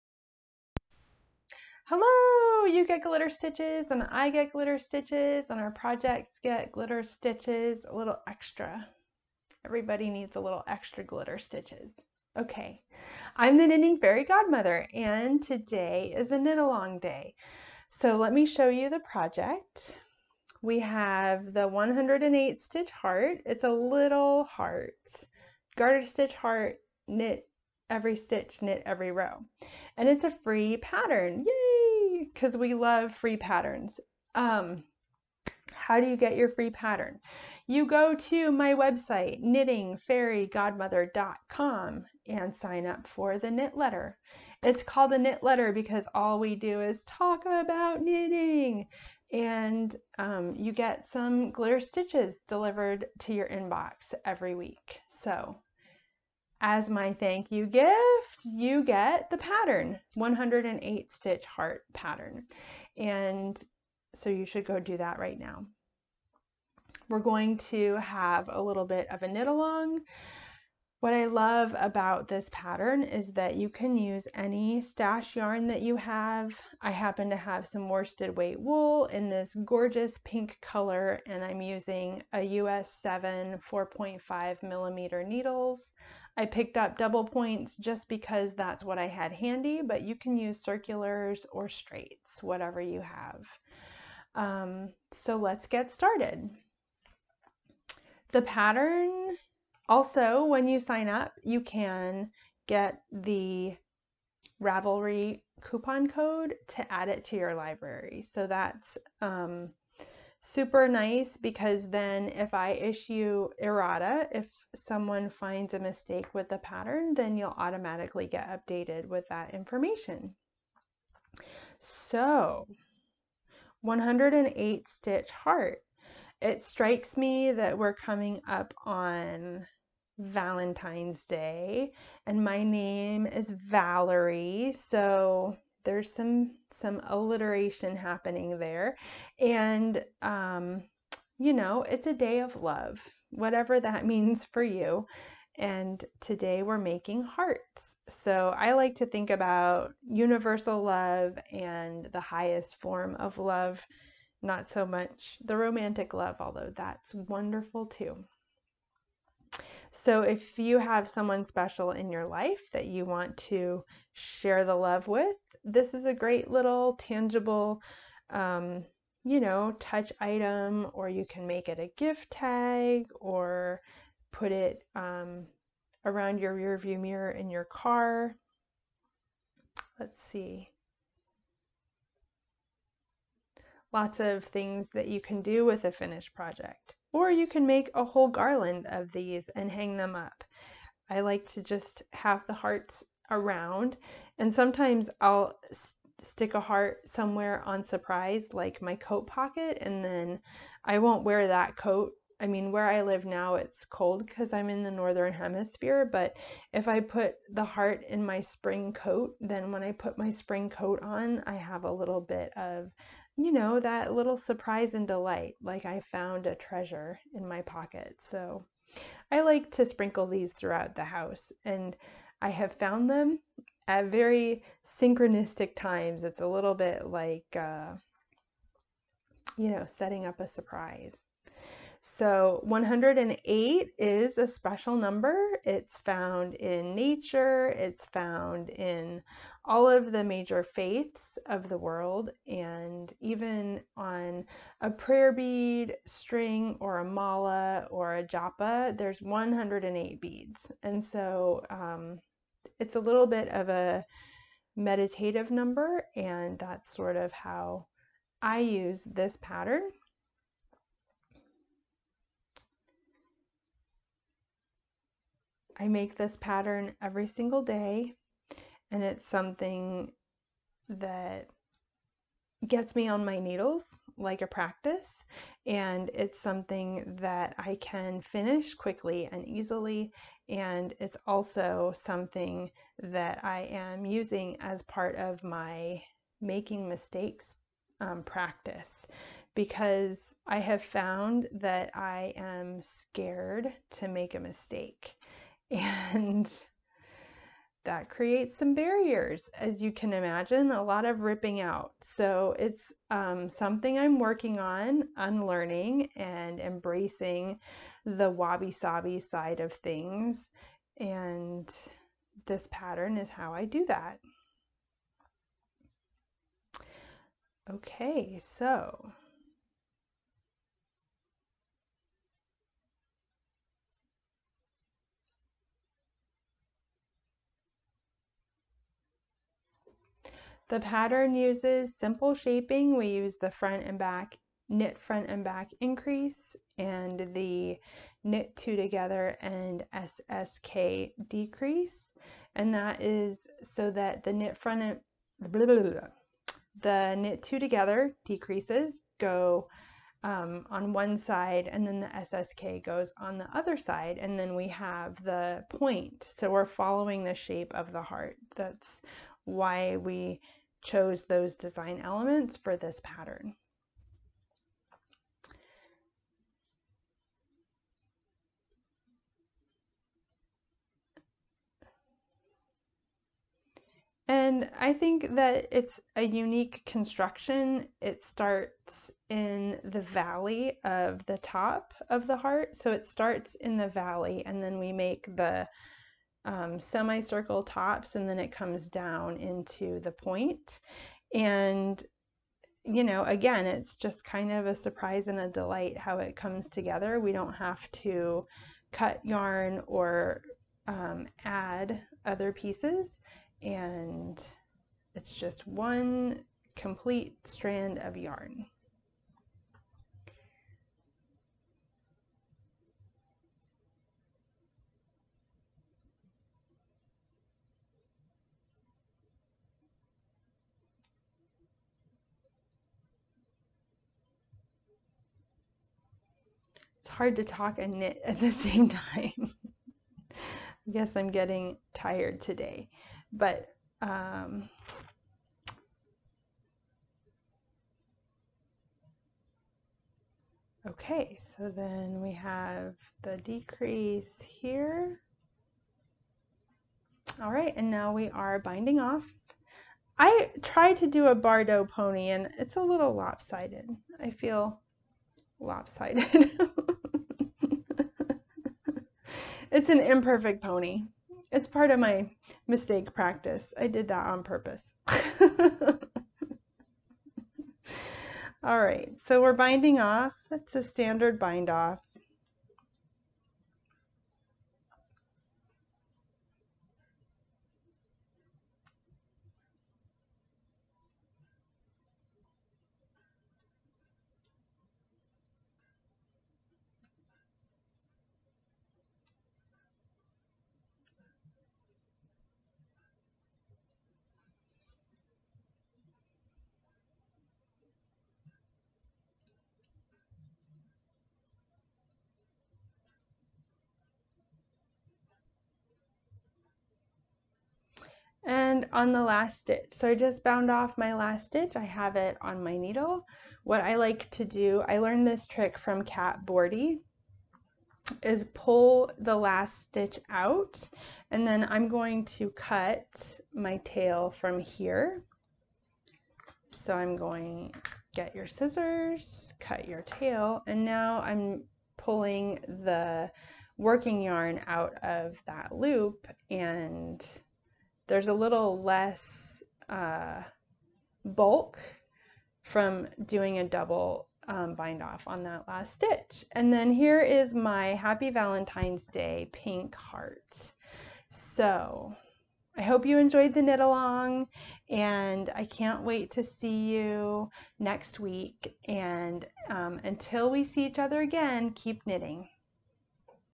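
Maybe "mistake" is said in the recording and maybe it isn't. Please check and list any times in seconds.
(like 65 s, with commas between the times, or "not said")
115 s, 286 s, 294 s, 462 s.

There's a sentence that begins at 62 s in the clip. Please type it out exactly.
And so you should go do that right now.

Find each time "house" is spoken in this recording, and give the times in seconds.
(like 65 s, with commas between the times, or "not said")
221 s.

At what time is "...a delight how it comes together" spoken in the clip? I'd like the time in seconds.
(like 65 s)
395 s.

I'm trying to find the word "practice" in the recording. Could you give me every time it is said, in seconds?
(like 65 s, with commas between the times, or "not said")
274 s, 288 s, 463 s.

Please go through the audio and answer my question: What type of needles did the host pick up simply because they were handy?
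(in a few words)
double points.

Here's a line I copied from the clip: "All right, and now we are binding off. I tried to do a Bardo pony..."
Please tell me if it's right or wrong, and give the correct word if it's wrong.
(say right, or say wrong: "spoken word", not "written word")
right.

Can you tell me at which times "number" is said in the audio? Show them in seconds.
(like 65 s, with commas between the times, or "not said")
234 s, 255 s.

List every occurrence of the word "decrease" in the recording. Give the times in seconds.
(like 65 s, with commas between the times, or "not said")
341 s, 348 s, 443 s.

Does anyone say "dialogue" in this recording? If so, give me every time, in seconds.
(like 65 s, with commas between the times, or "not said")
not said.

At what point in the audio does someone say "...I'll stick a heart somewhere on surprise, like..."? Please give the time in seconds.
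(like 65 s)
195 s.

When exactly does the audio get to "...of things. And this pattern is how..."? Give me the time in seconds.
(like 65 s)
309 s.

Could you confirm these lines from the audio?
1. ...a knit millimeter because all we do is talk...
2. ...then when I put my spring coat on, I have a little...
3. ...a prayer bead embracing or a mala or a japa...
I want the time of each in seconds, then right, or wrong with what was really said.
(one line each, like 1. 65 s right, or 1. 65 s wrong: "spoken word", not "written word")
1. 45 s wrong: "letter", not "millimeter"
2. 209 s right
3. 244 s wrong: "string", not "embracing".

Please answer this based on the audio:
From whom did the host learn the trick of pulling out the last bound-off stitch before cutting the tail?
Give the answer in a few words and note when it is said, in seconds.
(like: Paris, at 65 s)
Cat Bordhi, at 516 s.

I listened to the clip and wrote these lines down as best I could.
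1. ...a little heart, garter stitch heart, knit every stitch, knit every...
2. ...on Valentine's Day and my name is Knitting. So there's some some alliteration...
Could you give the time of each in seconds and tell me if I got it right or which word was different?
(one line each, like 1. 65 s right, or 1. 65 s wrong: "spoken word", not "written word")
1. 23 s right
2. 128 s wrong: "Valerie", not "Knitting".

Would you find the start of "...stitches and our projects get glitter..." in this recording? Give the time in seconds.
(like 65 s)
4 s.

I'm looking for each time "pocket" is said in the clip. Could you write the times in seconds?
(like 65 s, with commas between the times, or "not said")
199 s, 217 s.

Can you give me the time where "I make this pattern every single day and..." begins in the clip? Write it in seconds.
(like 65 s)
265 s.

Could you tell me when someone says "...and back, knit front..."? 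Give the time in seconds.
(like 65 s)
333 s.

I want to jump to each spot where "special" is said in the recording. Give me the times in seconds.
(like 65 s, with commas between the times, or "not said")
161 s, 234 s.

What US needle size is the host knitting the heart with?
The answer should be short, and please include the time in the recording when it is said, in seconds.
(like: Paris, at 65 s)
US 7, at 82 s.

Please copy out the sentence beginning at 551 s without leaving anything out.
So I hope you enjoyed the knit along and I can't wait to see you next week.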